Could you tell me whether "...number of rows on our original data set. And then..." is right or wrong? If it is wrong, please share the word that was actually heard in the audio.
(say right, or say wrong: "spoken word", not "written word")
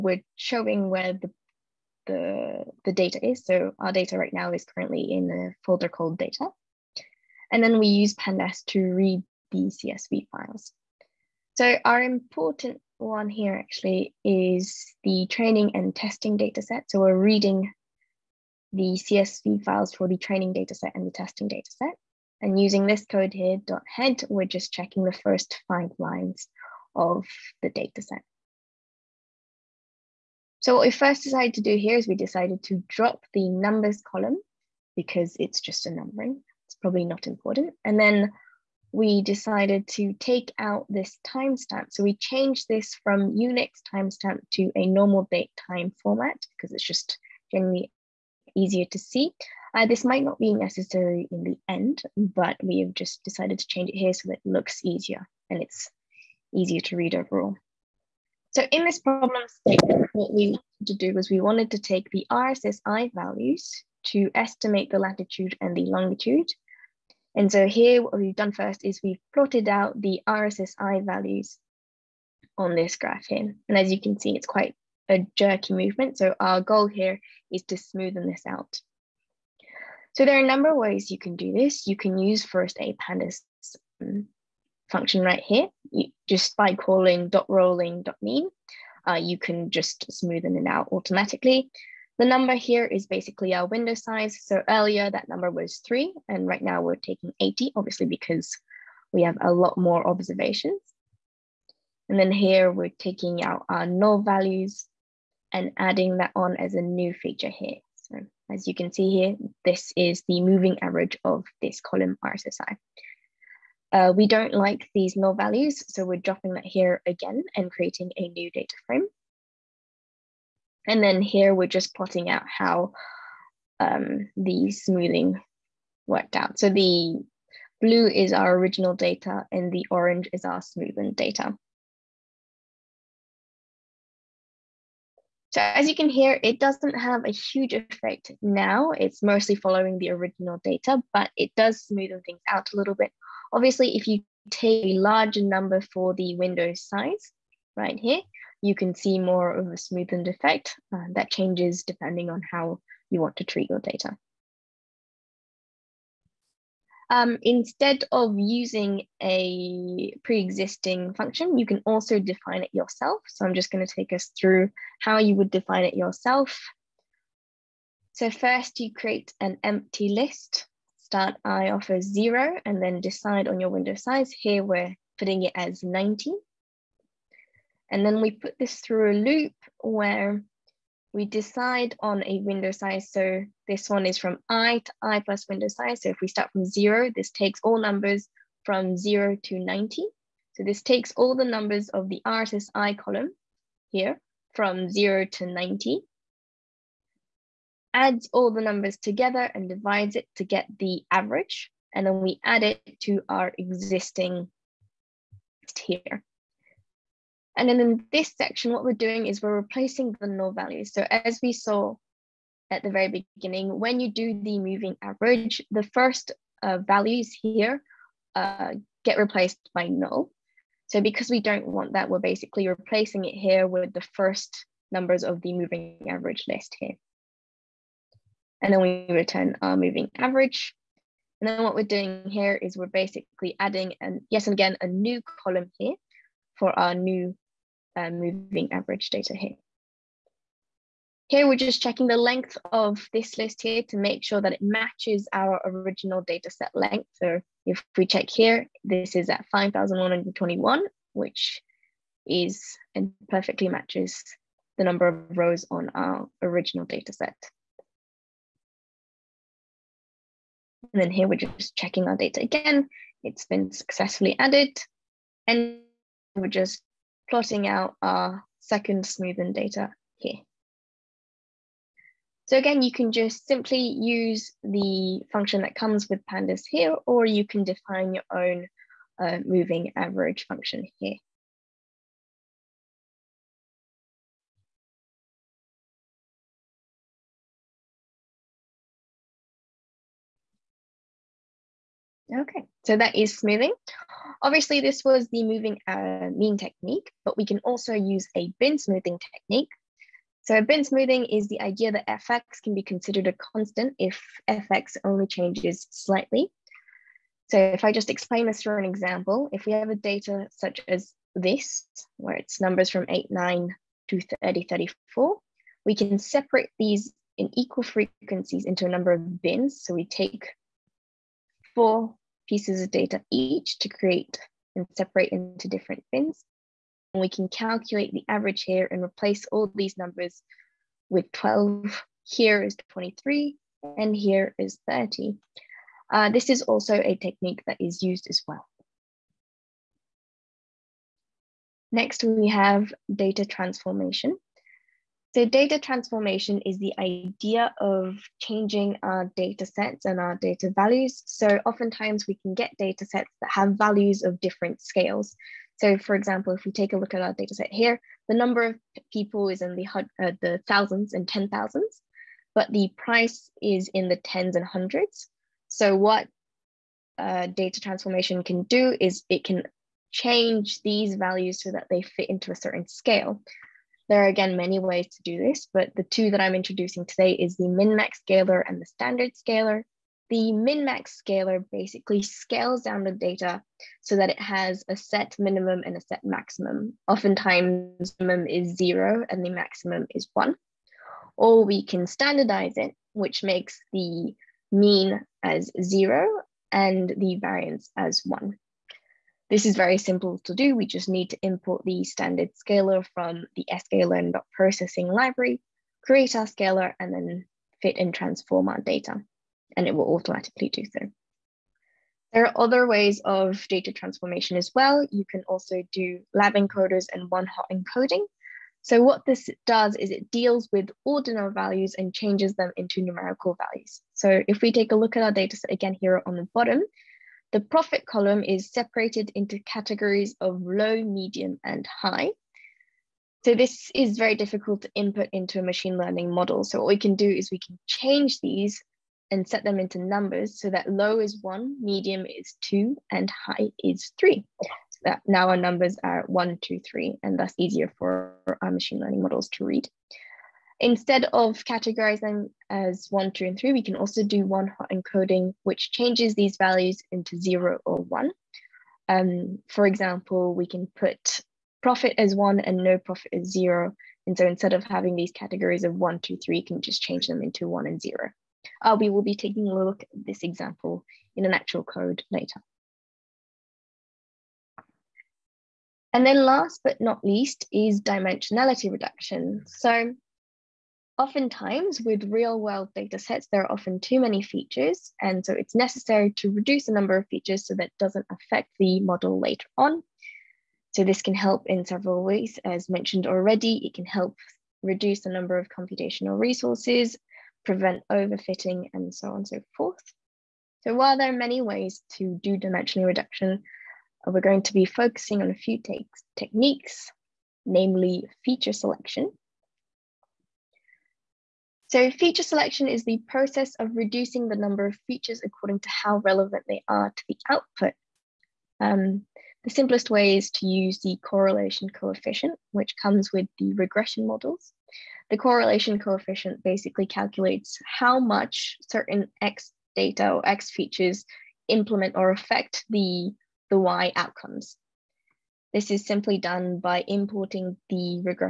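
right.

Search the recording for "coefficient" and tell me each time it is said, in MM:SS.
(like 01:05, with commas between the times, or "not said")
08:41, 08:45.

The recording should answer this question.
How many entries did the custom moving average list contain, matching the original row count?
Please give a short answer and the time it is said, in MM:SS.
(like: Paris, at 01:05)
5,121, at 04:09.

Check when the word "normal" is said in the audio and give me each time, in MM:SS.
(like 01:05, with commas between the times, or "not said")
00:44.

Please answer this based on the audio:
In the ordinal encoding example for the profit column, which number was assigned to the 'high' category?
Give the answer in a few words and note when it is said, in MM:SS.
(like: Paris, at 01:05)
3, at 07:23.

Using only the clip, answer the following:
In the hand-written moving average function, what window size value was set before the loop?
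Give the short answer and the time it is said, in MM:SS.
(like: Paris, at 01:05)
90, at 02:54.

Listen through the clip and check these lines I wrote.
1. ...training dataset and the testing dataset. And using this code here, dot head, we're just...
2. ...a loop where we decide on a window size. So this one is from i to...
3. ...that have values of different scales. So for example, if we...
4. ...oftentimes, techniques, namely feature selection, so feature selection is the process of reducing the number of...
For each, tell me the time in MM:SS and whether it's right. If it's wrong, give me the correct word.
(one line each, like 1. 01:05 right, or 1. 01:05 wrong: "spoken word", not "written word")
1. 00:20 right
2. 02:59 right
3. 05:53 right
4. 08:25 wrong: "takes", not "oftentimes".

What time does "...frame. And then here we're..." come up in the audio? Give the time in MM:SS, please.
01:58.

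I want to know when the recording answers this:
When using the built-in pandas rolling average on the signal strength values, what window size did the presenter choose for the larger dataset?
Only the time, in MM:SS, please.
01:36.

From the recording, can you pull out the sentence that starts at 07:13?
So this is very difficult to input into a machine learning model.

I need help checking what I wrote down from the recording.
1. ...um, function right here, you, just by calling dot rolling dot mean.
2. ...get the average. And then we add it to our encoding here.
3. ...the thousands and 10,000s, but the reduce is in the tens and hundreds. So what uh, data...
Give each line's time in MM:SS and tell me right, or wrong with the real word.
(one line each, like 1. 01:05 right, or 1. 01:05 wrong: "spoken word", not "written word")
1. 01:24 right
2. 03:20 wrong: "existing", not "encoding"
3. 06:00 wrong: "price", not "reduce".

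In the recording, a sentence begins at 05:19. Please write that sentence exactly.
So we take four pieces of data each to create and separate into different bins.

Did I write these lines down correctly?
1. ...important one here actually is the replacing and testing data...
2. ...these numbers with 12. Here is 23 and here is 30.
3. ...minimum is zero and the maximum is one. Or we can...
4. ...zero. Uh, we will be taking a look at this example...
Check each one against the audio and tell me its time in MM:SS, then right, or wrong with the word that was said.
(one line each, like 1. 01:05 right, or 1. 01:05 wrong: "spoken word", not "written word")
1. 00:12 wrong: "training", not "replacing"
2. 05:29 right
3. 06:28 right
4. 07:47 right.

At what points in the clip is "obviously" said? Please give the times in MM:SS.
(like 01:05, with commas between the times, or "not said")
01:37, 02:23, 04:54.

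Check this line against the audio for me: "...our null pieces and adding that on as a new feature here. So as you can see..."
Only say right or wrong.
wrong.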